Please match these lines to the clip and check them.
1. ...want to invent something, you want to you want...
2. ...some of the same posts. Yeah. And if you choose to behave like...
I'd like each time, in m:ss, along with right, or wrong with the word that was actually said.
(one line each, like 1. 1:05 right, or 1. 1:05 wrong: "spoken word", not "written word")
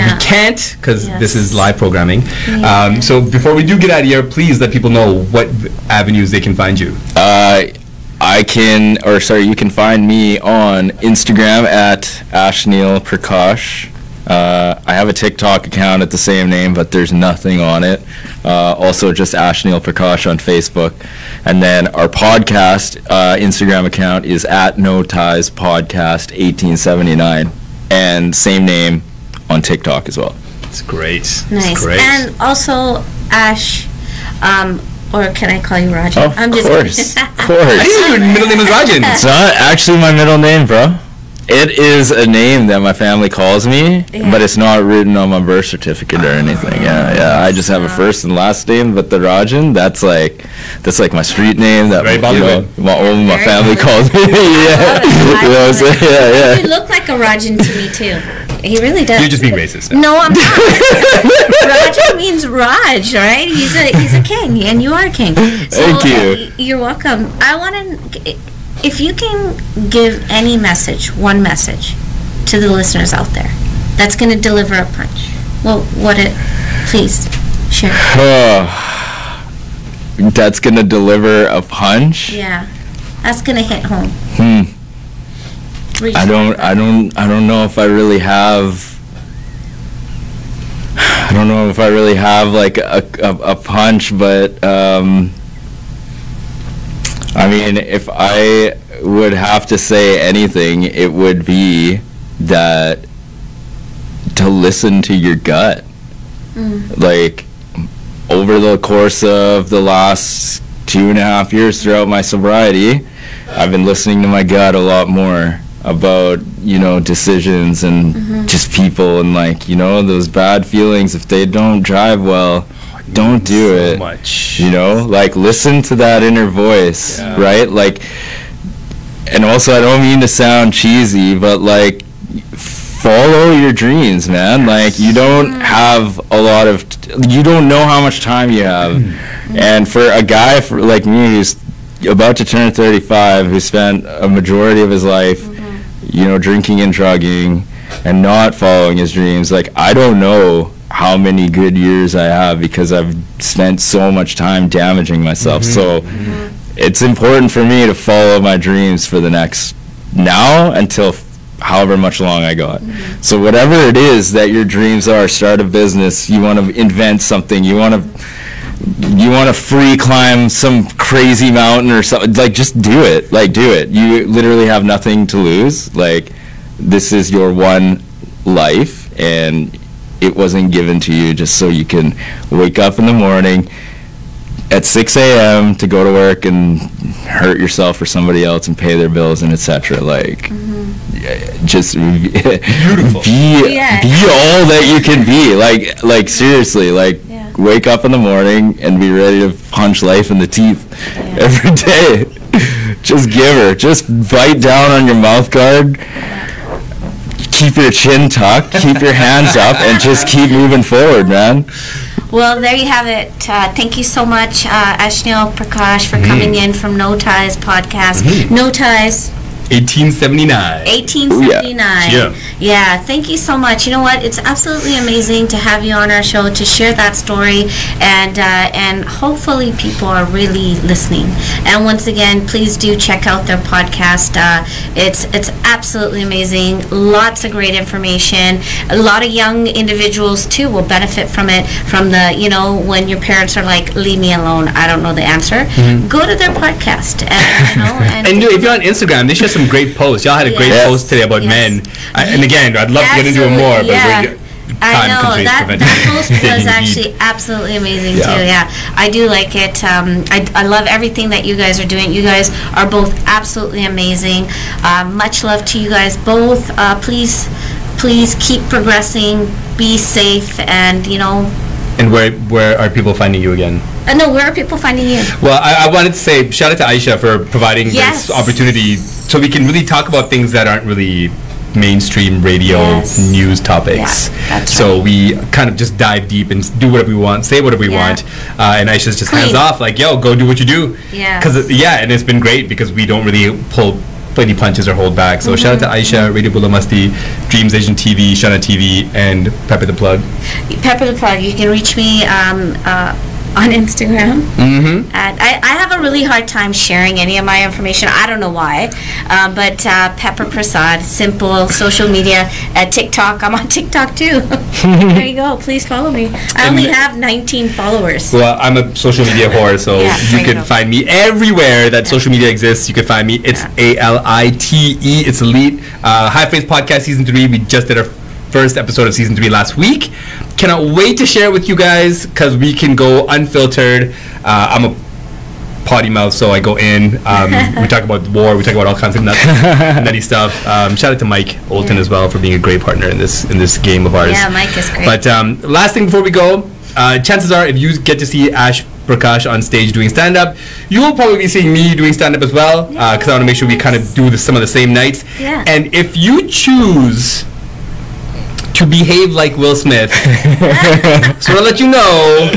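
1. 2:46 right
2. 5:54 wrong: "nights", not "posts".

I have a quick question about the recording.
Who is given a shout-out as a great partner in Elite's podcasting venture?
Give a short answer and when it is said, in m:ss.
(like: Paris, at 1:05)
Mike Olton, at 5:41.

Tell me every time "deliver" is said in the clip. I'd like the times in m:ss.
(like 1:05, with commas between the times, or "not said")
1:14, 1:20.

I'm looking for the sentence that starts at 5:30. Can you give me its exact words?
Cannot wait to share it with you guys because we can go unfiltered.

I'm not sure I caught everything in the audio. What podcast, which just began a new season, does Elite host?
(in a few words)
High Face Podcast.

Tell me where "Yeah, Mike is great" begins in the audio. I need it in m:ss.
5:44.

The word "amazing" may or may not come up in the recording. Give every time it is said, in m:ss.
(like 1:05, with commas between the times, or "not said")
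3:44, 3:56, 4:17, 4:23.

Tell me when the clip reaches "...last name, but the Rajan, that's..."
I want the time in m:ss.
0:48.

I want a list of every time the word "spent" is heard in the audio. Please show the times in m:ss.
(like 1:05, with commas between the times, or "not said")
2:23, 2:33.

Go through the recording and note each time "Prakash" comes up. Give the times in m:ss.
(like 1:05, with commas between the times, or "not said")
0:12, 0:19, 3:34, 5:49.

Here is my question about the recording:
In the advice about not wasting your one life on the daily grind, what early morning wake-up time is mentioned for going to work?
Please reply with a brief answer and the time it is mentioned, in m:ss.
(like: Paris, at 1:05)
6 a.m., at 3:04.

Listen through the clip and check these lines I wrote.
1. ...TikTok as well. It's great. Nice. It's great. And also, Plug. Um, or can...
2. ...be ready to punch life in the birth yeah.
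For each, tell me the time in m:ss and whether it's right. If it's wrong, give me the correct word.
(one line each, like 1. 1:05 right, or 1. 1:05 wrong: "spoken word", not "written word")
1. 0:29 wrong: "Ash", not "Plug"
2. 3:18 wrong: "teeth", not "birth".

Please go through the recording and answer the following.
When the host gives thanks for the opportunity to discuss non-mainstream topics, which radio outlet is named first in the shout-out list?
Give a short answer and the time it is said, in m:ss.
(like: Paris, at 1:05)
Radio Bulamasti, at 4:56.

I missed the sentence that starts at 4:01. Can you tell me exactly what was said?
From the you know when your parents are like, leave me alone.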